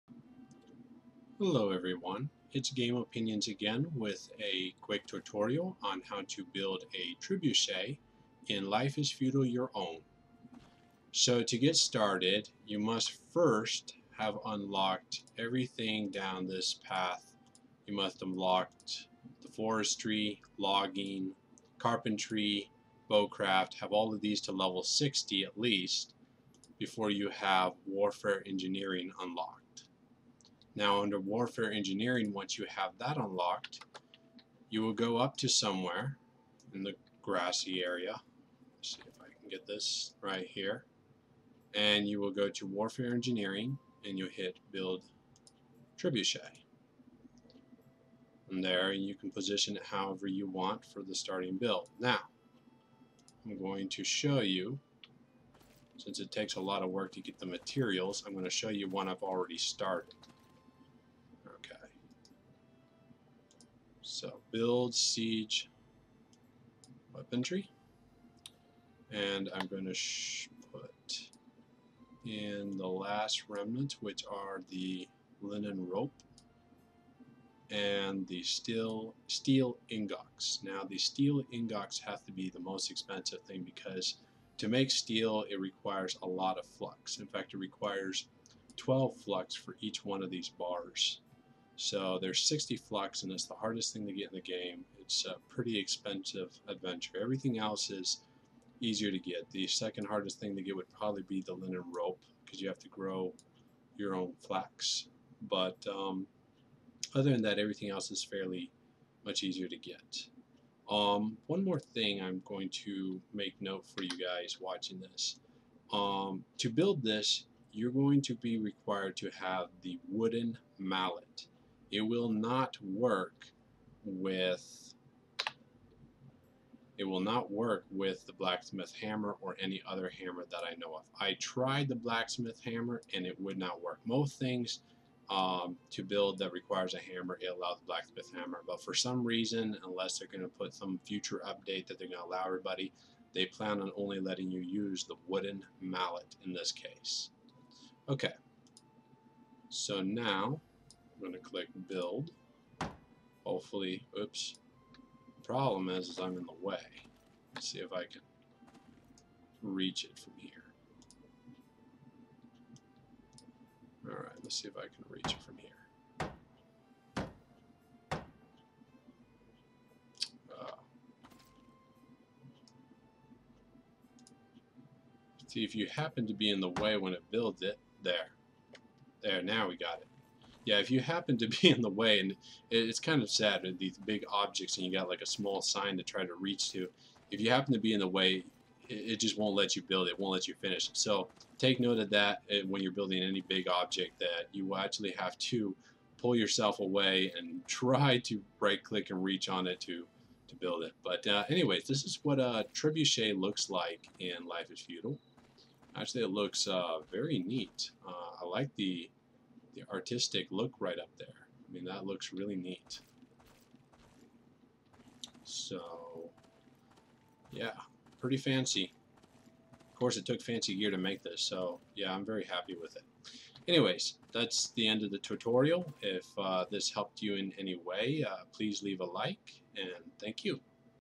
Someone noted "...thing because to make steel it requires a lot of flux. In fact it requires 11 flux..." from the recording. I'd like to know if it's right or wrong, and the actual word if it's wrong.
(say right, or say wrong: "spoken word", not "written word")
wrong: "12", not "11".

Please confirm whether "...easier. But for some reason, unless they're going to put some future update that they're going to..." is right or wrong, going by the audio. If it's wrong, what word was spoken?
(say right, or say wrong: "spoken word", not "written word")
wrong: "hammer", not "easier".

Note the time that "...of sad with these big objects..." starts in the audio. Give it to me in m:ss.
3:03.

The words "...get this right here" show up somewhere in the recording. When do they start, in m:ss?
0:39.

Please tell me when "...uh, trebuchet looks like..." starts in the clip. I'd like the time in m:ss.
3:22.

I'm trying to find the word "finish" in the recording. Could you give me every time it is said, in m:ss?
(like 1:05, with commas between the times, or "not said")
3:10.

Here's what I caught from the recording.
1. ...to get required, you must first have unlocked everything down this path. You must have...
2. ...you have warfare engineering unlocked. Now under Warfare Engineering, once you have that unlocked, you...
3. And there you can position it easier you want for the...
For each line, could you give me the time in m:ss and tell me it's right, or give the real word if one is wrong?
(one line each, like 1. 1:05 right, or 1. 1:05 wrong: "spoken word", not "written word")
1. 0:11 wrong: "started", not "required"
2. 0:27 right
3. 0:48 wrong: "however", not "easier".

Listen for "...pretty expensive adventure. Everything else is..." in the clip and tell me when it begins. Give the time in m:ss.
1:35.